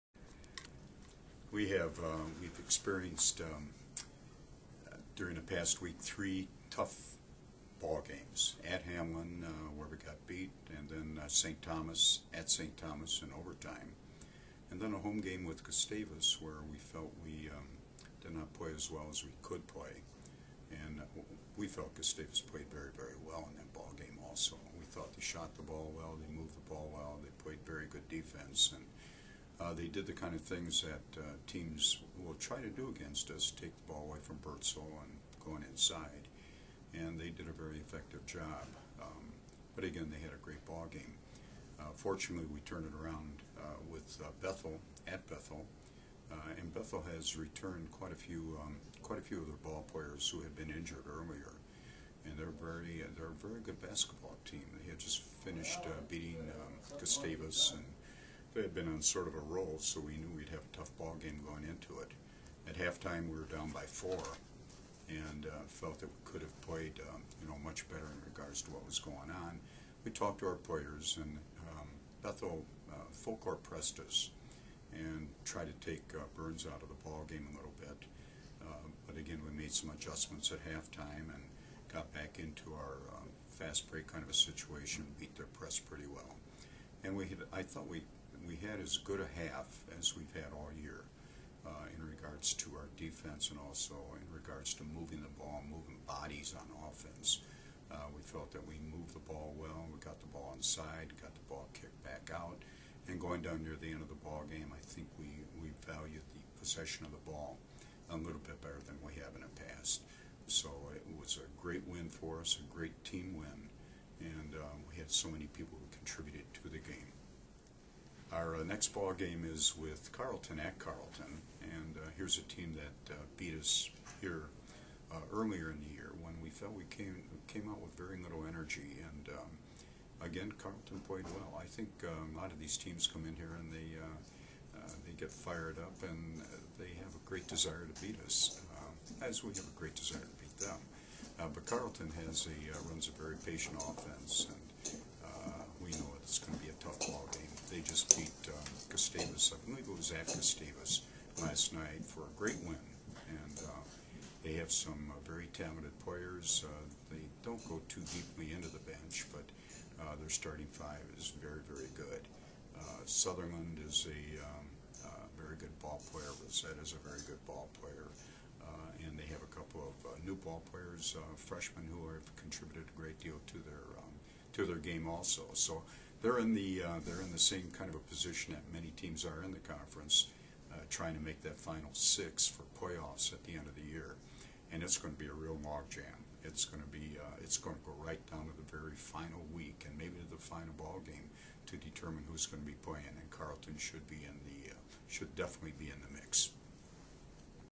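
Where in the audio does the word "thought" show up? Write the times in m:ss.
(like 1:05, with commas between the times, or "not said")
0:24, 1:27.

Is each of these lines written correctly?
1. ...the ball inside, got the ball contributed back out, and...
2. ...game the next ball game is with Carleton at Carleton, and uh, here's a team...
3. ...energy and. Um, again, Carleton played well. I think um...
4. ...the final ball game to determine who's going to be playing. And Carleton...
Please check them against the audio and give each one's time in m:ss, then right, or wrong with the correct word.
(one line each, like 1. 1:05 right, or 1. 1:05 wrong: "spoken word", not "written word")
1. 1:40 wrong: "kicked", not "contributed"
2. 1:56 right
3. 2:08 right
4. 3:10 right.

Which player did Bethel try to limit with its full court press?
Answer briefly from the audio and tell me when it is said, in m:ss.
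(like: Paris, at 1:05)
Burns, at 1:16.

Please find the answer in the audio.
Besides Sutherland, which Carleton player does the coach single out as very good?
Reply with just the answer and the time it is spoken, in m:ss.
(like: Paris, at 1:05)
Rosette, at 2:46.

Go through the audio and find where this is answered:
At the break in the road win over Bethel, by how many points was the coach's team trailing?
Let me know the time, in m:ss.
1:03.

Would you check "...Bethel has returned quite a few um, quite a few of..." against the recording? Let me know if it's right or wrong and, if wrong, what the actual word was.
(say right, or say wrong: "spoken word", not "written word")
right.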